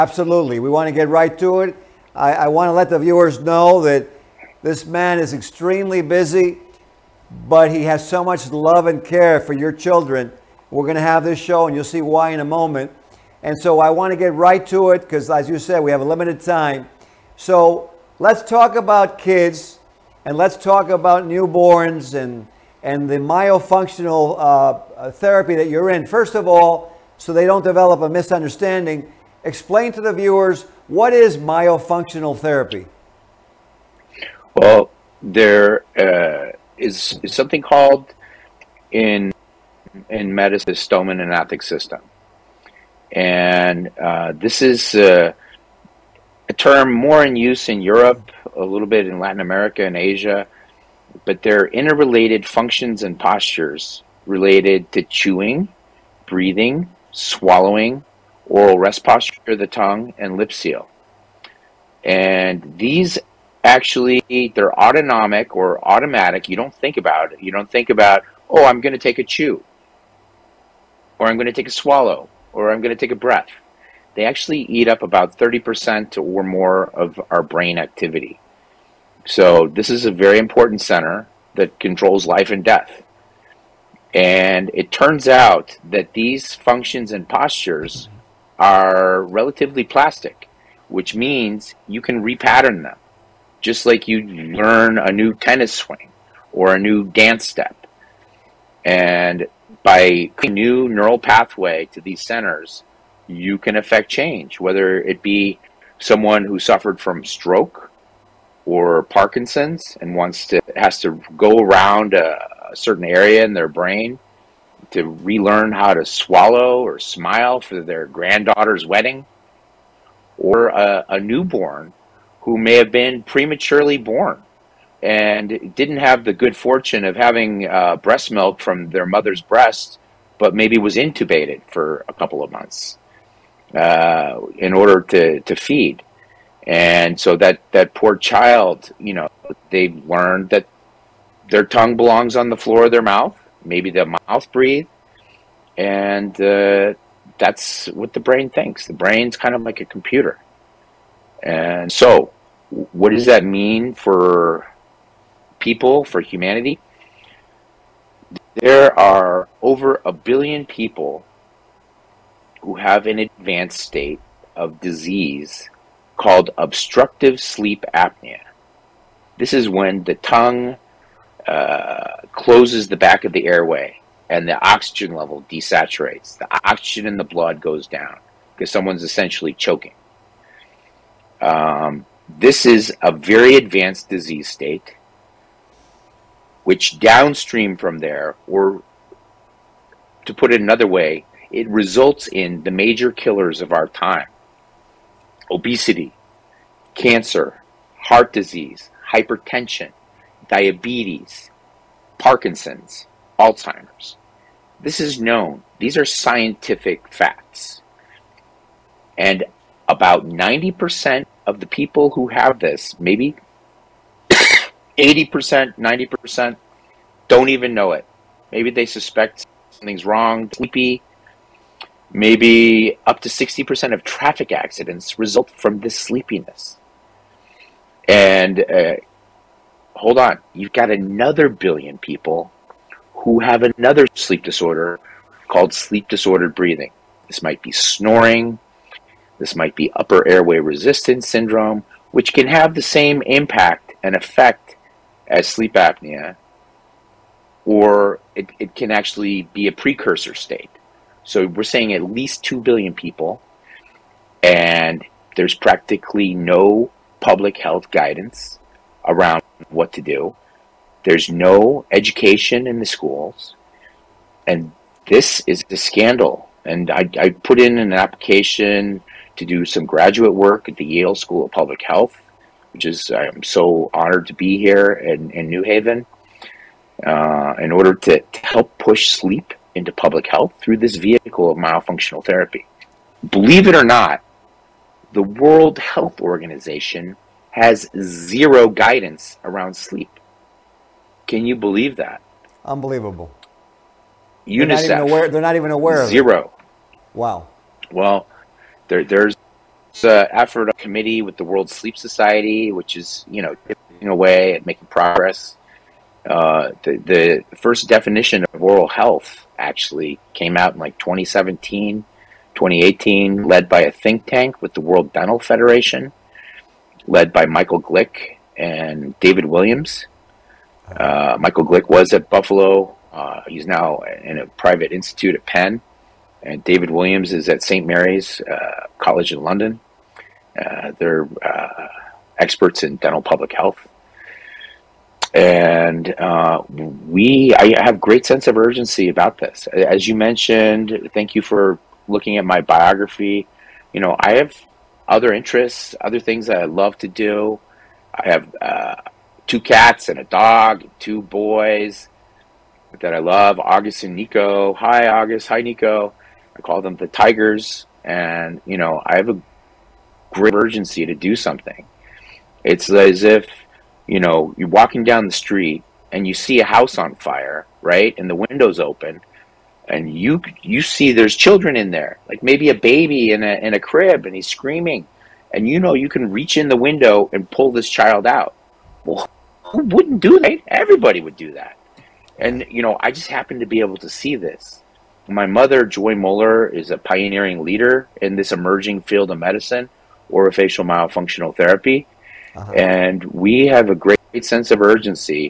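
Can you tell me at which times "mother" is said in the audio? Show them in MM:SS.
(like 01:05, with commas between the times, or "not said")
02:09, 06:25.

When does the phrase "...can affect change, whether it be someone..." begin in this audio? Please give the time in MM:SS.
01:43.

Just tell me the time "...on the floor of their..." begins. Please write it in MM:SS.
02:22.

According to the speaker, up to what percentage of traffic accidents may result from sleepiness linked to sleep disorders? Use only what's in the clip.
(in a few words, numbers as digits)
60%.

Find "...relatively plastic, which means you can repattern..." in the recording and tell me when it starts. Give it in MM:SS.
01:29.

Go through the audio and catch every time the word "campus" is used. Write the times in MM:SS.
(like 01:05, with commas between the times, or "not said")
not said.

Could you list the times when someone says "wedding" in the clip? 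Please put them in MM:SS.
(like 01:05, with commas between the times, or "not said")
01:58.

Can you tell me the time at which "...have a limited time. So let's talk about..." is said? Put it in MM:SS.
00:15.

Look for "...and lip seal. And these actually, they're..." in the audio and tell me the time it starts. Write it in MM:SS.
01:00.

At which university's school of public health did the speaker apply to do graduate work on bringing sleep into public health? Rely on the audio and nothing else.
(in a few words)
Yale.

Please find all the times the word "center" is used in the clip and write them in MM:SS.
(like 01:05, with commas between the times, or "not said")
01:20, 01:42.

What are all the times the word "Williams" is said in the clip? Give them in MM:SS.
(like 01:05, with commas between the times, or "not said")
05:19, 05:26.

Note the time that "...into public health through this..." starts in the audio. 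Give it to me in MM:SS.
04:39.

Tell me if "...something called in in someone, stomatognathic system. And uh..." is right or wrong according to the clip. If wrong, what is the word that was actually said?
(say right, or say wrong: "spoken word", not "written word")
wrong: "medicine", not "someone".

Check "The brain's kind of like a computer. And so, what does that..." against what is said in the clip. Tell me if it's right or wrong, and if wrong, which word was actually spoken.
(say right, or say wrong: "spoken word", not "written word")
right.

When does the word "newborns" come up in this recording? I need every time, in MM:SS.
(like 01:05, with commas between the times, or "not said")
00:21, 02:01.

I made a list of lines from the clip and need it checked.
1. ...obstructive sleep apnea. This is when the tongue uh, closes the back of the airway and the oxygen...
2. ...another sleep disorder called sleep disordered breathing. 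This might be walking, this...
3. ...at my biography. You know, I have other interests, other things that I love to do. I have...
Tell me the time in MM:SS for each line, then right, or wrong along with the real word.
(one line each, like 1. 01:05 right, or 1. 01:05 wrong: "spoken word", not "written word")
1. 02:46 right
2. 03:53 wrong: "snoring", not "walking"
3. 05:42 right.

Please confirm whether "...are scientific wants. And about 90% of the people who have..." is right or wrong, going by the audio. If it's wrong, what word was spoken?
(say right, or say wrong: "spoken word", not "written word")
wrong: "facts", not "wants".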